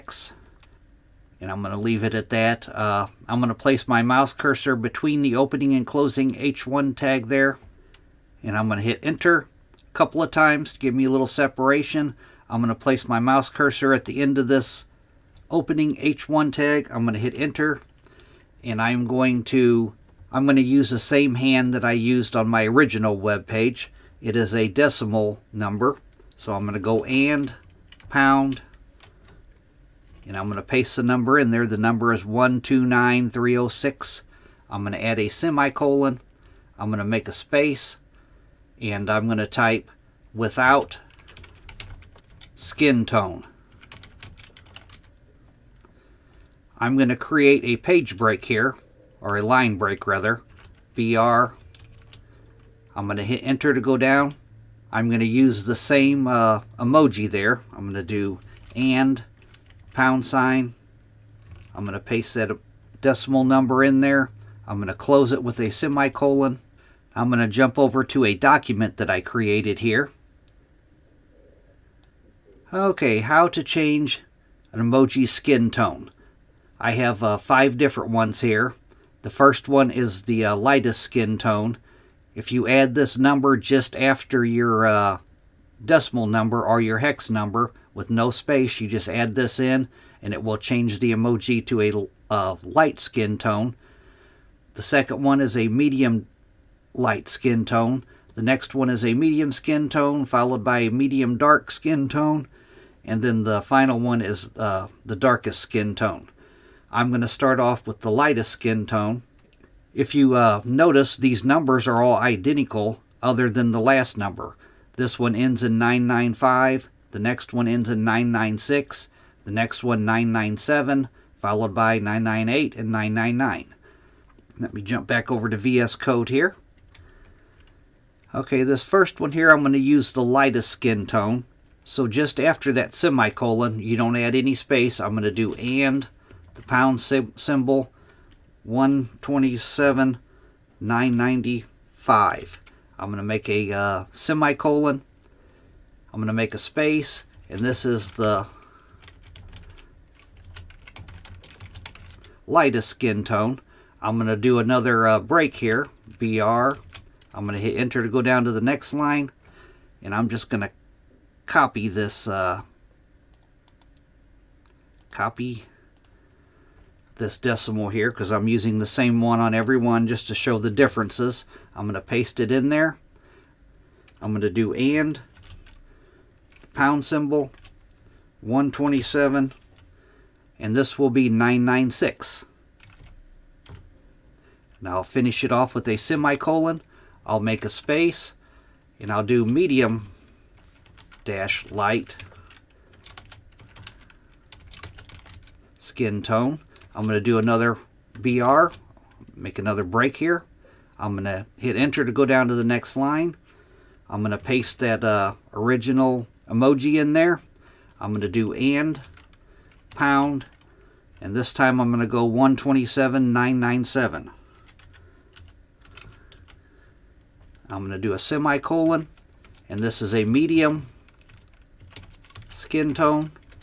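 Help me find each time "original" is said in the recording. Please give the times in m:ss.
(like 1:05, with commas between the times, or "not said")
0:22, 3:25.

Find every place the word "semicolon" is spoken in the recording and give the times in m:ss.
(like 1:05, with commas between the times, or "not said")
0:35, 1:05, 2:12, 2:24, 3:05, 3:38.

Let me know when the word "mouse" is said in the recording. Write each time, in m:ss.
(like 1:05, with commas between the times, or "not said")
0:04, 0:13.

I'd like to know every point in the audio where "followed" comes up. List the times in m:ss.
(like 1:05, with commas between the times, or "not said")
1:40, 2:01.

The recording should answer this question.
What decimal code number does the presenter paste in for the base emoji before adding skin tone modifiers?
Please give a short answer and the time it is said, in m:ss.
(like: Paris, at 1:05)
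129306, at 0:32.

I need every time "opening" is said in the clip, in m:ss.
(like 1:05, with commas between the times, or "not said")
0:05, 0:15.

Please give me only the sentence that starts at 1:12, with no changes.
Okay, how to change an emoji skin tone.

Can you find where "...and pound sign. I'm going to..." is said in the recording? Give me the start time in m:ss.
0:58.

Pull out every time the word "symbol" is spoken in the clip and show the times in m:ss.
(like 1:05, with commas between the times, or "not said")
2:16, 2:57.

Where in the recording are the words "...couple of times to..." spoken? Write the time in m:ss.
0:09.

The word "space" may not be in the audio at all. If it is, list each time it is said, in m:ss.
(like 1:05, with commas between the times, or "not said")
0:37, 1:28, 2:14, 2:26, 3:07.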